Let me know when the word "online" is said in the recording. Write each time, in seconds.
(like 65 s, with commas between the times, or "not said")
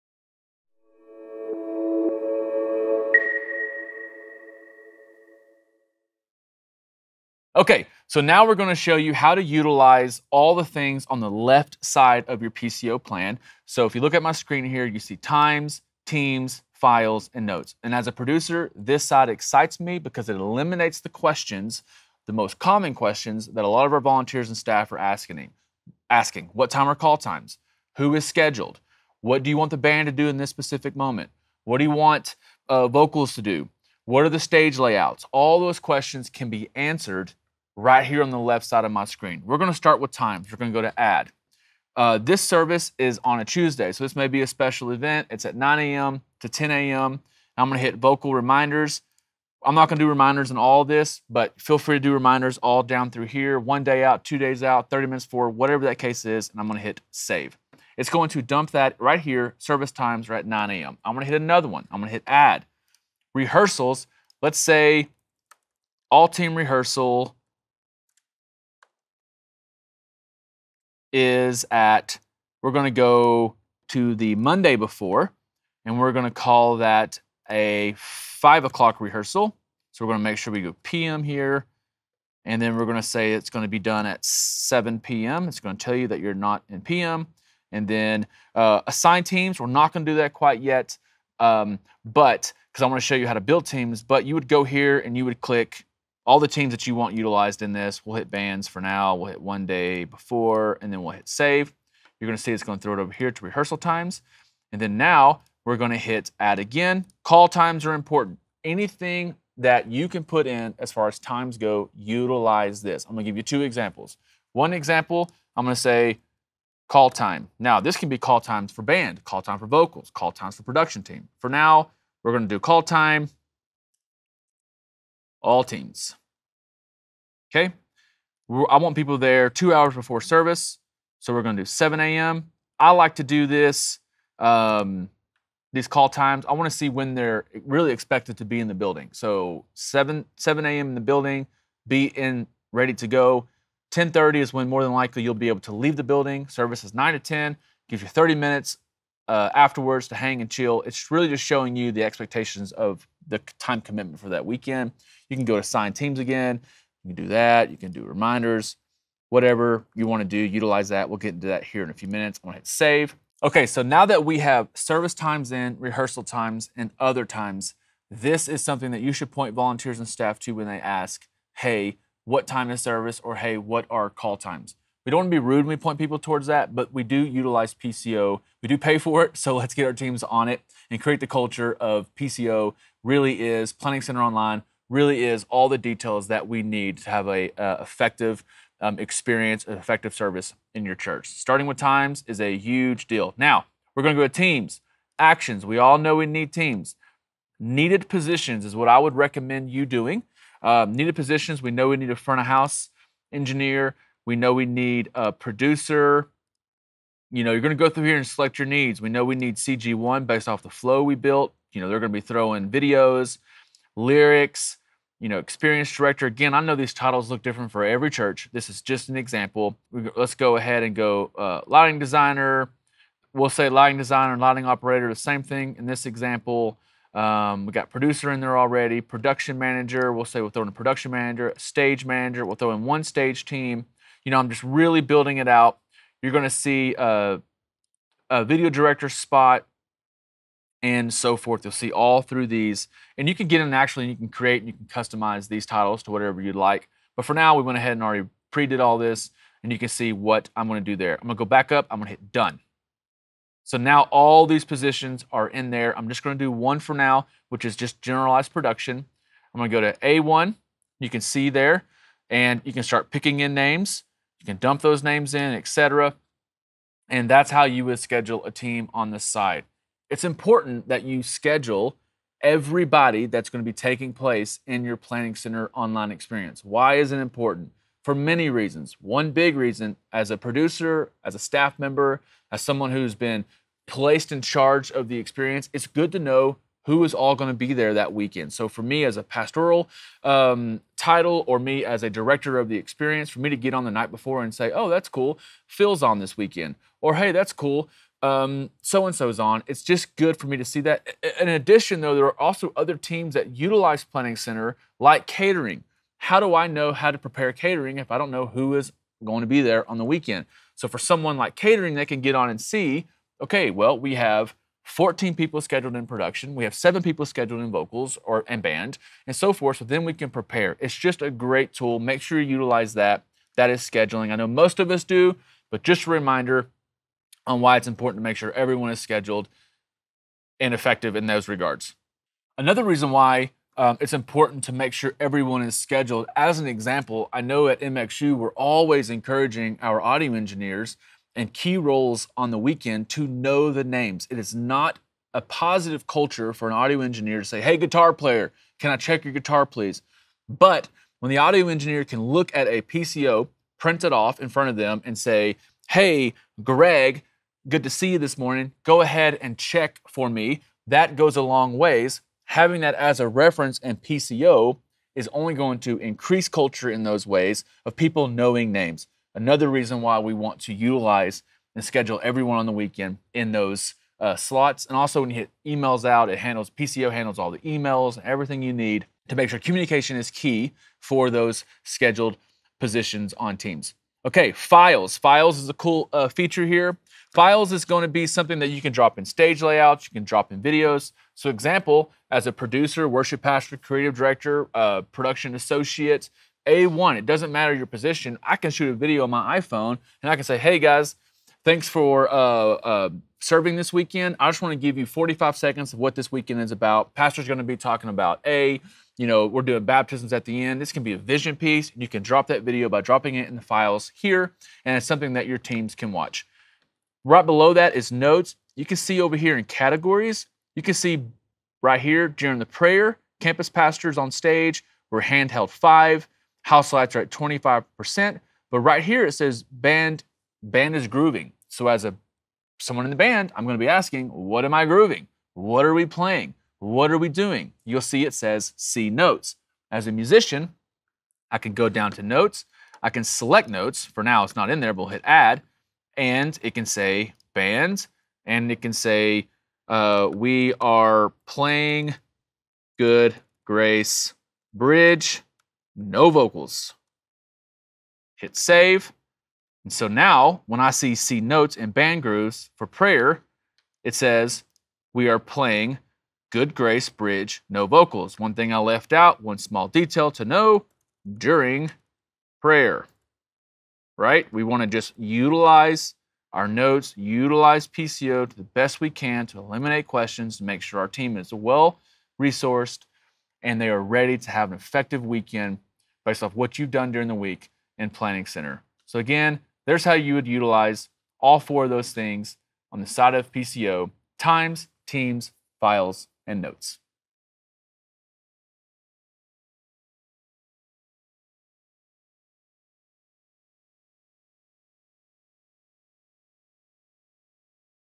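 184 s, 275 s.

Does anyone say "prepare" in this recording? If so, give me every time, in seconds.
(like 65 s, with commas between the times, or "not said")
307 s, 320 s.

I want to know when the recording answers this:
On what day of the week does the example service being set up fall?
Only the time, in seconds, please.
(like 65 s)
43 s.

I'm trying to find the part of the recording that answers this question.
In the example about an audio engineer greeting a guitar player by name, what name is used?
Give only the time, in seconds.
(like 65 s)
356 s.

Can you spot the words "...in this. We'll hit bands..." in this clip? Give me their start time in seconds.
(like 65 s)
97 s.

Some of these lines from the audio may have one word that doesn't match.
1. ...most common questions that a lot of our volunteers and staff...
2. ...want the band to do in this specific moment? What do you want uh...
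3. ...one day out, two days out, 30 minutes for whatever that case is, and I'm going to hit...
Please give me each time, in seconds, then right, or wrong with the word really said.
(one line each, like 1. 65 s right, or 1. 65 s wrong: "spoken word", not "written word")
1. 22 s right
2. 29 s right
3. 53 s right.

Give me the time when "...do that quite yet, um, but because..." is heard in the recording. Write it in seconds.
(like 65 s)
90 s.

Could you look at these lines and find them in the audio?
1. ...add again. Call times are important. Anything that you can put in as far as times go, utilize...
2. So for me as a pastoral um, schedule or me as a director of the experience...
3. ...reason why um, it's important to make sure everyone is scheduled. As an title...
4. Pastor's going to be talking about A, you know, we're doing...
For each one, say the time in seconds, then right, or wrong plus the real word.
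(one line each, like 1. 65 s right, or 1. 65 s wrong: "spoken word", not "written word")
1. 106 s right
2. 288 s wrong: "title", not "schedule"
3. 332 s wrong: "example", not "title"
4. 407 s right.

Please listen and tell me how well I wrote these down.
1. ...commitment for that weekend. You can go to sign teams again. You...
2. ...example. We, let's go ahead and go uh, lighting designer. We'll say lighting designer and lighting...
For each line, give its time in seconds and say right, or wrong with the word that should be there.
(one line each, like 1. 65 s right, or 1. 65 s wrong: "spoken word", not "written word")
1. 153 s right
2. 219 s right.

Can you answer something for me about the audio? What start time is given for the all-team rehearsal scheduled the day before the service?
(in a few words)
5 p.m.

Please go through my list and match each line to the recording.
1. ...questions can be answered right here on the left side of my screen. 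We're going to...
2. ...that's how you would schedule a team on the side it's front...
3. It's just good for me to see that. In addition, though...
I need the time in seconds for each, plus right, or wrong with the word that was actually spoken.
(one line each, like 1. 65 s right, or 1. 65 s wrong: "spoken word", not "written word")
1. 35 s right
2. 267 s wrong: "important", not "front"
3. 299 s right.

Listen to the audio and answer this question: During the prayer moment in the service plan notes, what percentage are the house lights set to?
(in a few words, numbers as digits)
25%.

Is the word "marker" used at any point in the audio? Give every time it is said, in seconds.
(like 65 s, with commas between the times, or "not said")
not said.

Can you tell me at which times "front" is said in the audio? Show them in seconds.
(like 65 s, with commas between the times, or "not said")
202 s, 354 s.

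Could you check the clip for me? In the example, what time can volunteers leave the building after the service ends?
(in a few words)
10:30.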